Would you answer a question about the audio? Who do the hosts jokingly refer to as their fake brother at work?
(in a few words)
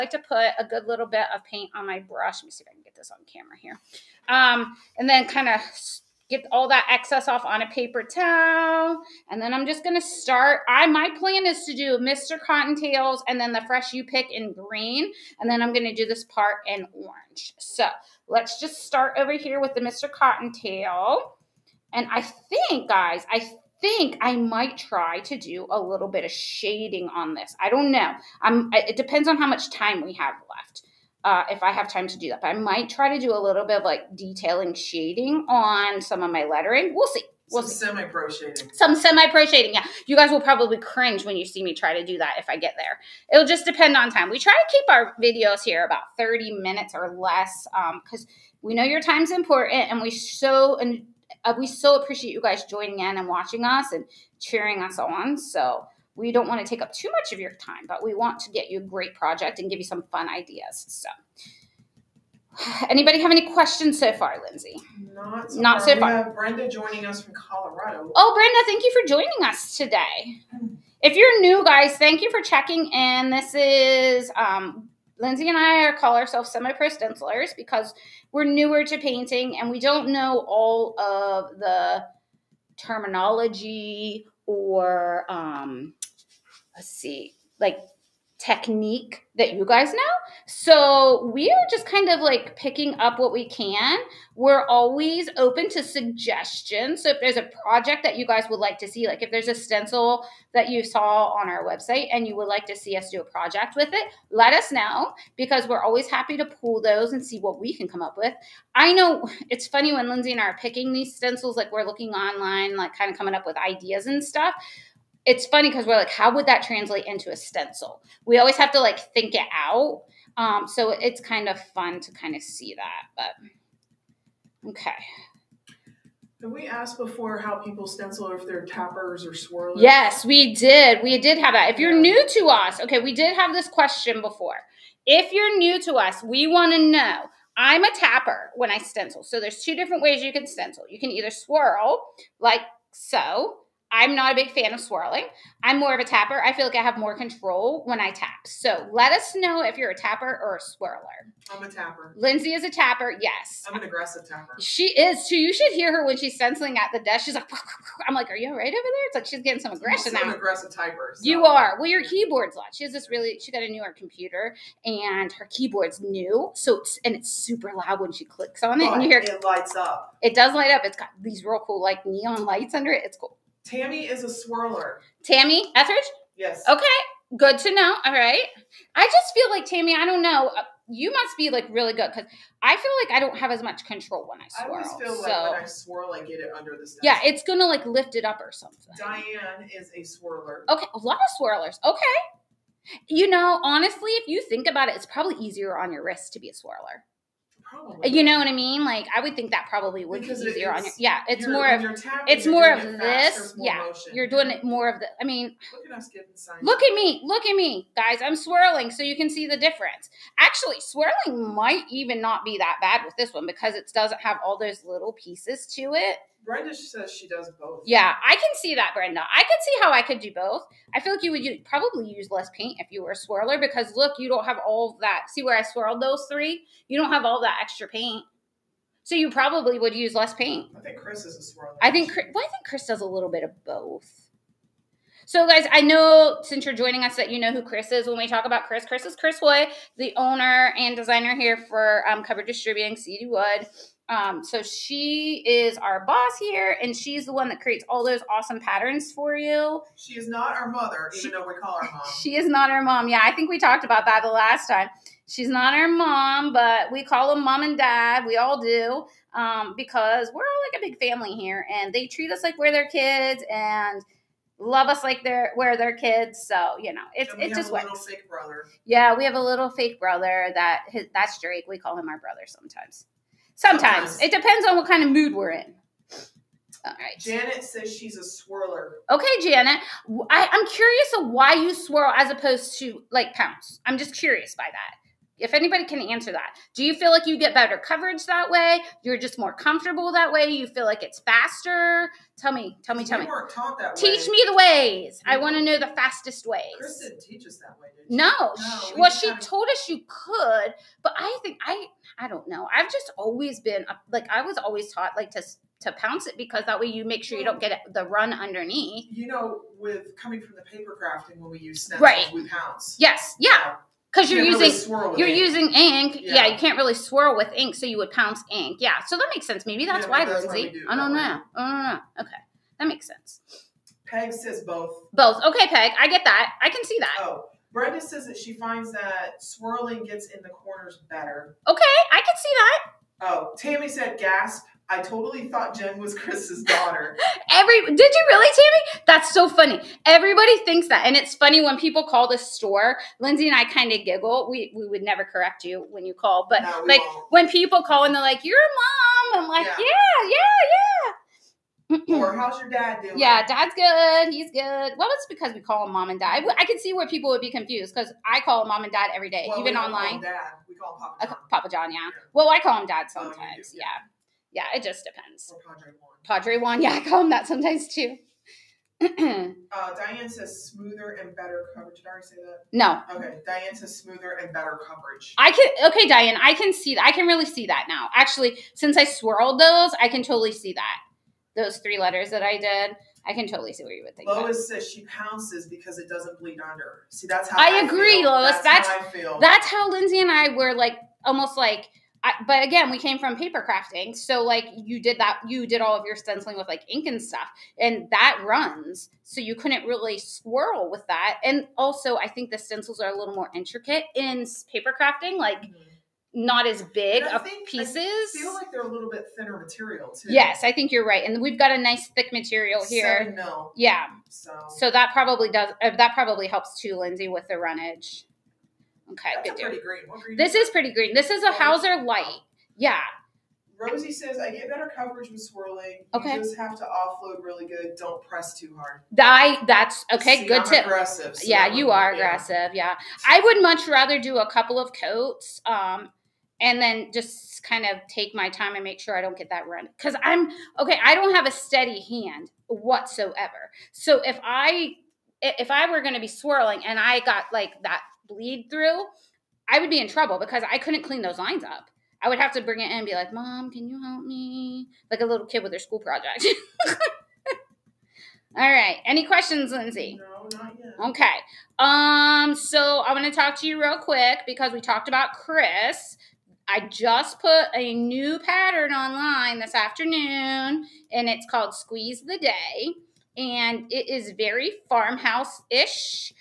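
Drake.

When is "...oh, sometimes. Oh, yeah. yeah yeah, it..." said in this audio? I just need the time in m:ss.
6:03.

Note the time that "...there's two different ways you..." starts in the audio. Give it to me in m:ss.
2:19.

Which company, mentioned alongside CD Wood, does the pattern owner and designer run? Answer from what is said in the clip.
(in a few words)
Cover Distributing.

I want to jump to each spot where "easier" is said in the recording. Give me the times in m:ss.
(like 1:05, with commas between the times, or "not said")
3:15, 3:20.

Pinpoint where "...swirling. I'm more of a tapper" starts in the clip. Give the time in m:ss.
2:24.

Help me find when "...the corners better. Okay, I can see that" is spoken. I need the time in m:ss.
5:30.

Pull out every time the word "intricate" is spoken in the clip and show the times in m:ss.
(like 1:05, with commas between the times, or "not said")
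6:43.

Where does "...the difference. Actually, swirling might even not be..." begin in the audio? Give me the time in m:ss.
3:29.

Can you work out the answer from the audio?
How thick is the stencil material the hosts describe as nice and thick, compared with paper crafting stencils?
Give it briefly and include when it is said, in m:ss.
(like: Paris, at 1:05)
7 mil, at 6:53.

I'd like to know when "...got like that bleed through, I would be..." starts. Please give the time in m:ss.
7:27.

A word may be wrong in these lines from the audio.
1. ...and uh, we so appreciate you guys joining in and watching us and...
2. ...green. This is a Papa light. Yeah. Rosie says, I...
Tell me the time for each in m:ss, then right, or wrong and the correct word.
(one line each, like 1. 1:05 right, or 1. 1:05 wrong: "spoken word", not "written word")
1. 0:50 right
2. 7:00 wrong: "Hauser", not "Papa".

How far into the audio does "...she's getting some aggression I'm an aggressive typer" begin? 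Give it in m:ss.
2:39.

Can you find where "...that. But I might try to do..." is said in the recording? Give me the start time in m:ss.
0:32.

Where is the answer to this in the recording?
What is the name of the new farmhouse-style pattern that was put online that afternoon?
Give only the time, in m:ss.
7:51.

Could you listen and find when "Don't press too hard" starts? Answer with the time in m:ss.
7:07.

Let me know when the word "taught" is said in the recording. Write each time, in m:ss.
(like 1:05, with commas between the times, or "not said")
4:53, 5:04.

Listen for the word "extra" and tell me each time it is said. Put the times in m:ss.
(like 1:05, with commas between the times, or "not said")
3:47.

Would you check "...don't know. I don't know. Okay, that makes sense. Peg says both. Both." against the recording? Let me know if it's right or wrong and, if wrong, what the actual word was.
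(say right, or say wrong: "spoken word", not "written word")
right.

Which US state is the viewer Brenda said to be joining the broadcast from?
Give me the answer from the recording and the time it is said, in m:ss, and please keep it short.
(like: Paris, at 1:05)
Colorado, at 1:07.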